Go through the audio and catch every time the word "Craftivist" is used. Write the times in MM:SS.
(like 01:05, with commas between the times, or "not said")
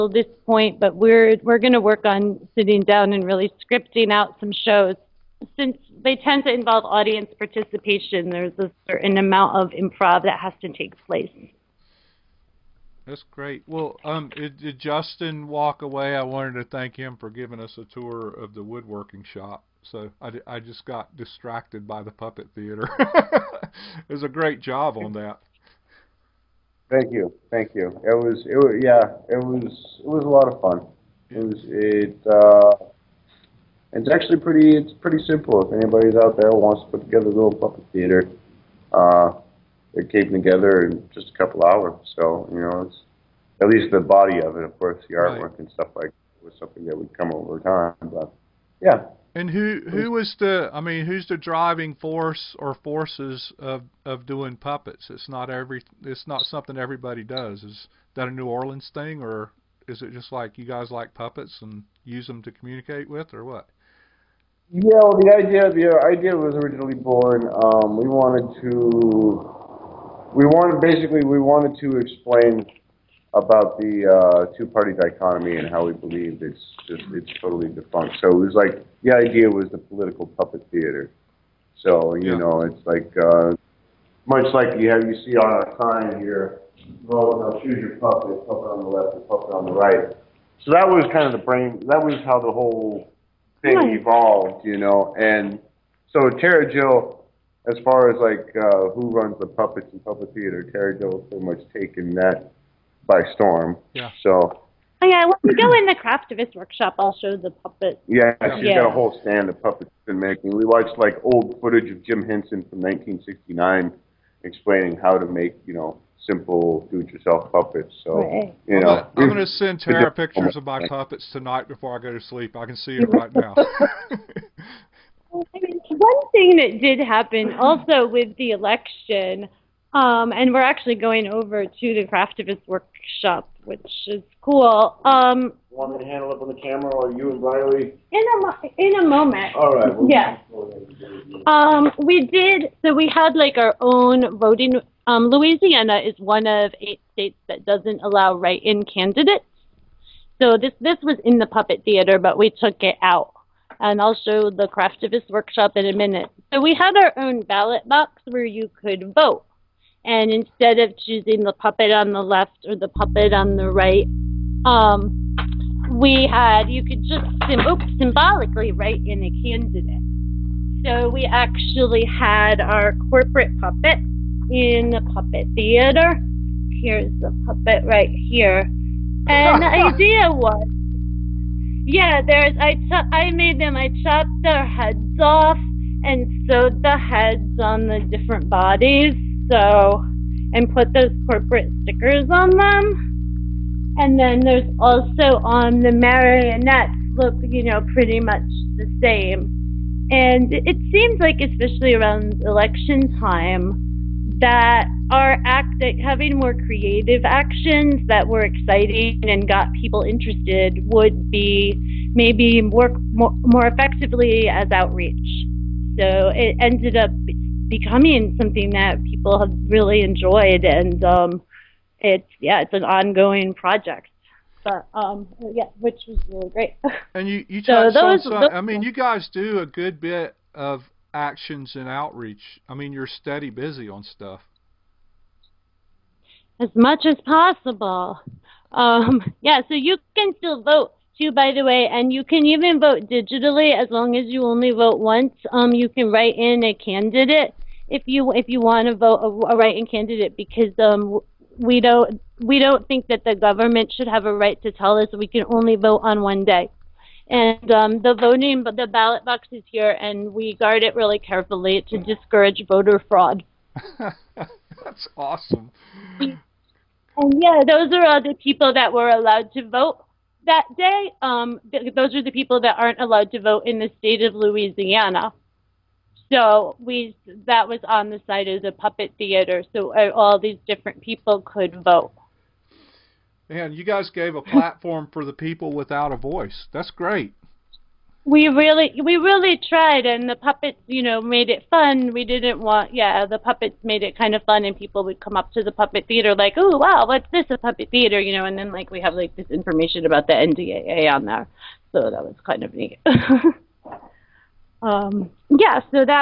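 01:46, 02:12, 02:34.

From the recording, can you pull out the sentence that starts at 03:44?
But um, yeah, which was really great.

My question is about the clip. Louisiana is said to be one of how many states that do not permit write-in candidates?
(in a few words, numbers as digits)
8.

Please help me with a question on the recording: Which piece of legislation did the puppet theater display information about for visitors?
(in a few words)
NDAA.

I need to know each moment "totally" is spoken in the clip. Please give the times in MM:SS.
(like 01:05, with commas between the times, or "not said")
01:17.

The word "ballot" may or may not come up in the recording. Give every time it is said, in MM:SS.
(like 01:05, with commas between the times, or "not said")
02:37, 04:18.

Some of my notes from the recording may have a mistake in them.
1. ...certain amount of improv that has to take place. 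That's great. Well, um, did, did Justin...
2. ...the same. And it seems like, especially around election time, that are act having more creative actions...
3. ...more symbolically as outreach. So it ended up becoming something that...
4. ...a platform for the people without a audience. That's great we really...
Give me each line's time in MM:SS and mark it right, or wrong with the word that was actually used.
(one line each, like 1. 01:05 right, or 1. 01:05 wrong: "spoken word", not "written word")
1. 00:08 right
2. 03:18 right
3. 03:33 wrong: "effectively", not "symbolically"
4. 04:44 wrong: "voice", not "audience".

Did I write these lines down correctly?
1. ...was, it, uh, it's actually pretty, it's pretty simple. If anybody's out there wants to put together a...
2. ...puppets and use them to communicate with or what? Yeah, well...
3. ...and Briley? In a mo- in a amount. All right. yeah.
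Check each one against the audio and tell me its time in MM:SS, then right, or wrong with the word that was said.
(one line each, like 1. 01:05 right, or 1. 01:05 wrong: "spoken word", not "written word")
1. 00:31 right
2. 01:01 right
3. 02:17 wrong: "moment", not "amount".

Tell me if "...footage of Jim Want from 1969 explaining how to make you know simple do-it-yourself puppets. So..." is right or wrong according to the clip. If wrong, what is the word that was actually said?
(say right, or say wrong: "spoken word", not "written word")
wrong: "Henson", not "Want".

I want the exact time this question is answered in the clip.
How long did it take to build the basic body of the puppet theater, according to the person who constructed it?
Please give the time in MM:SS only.
00:41.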